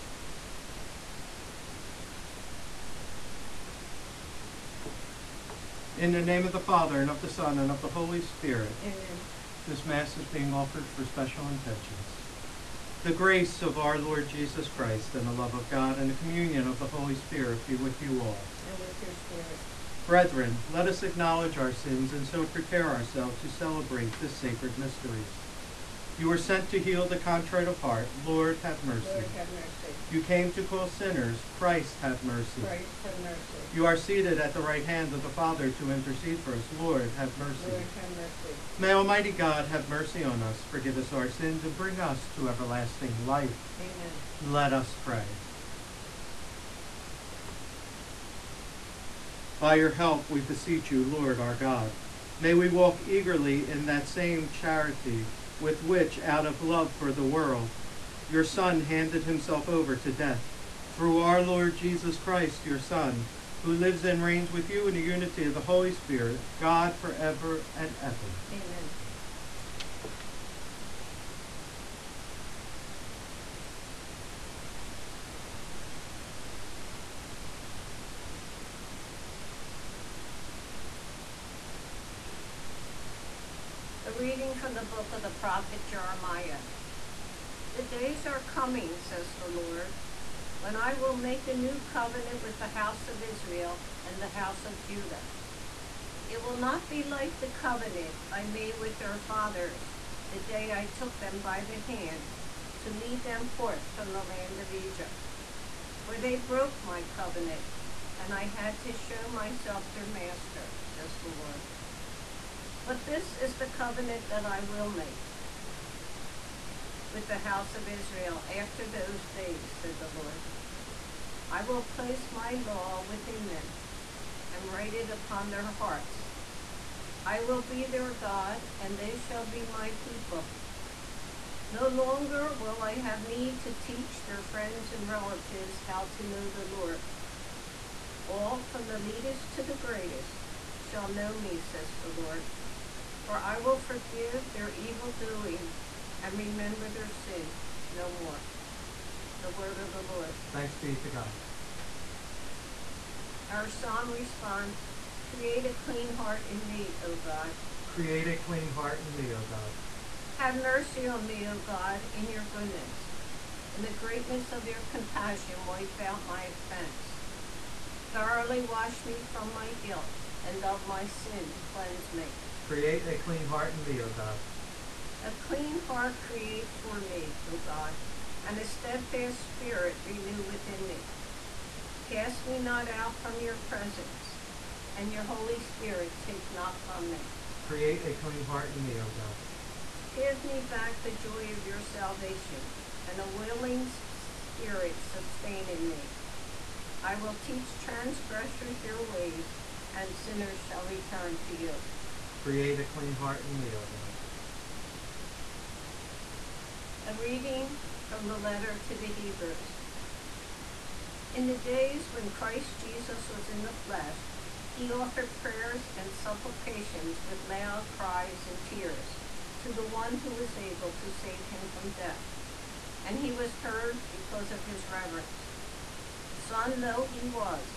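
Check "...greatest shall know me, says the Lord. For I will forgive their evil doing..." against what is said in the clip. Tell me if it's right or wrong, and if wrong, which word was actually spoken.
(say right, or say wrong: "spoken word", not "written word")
right.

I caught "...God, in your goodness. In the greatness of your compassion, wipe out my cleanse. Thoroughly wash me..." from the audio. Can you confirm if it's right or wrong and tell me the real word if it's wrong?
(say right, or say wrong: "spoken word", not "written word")
wrong: "offense", not "cleanse".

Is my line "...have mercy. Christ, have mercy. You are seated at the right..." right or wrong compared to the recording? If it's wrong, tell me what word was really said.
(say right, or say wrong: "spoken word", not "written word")
right.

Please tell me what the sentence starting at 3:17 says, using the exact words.
I will teach transgressors your ways, and sinners shall return to you.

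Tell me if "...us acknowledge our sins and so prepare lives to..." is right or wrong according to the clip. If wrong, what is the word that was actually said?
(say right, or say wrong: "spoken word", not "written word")
wrong: "ourselves", not "lives".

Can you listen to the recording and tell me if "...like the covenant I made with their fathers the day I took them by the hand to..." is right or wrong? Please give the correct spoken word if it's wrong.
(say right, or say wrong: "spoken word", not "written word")
right.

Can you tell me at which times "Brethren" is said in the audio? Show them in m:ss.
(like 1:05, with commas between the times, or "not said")
0:20.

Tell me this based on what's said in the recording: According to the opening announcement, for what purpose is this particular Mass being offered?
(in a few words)
Special intentions.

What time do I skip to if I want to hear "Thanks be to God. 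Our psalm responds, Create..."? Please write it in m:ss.
2:30.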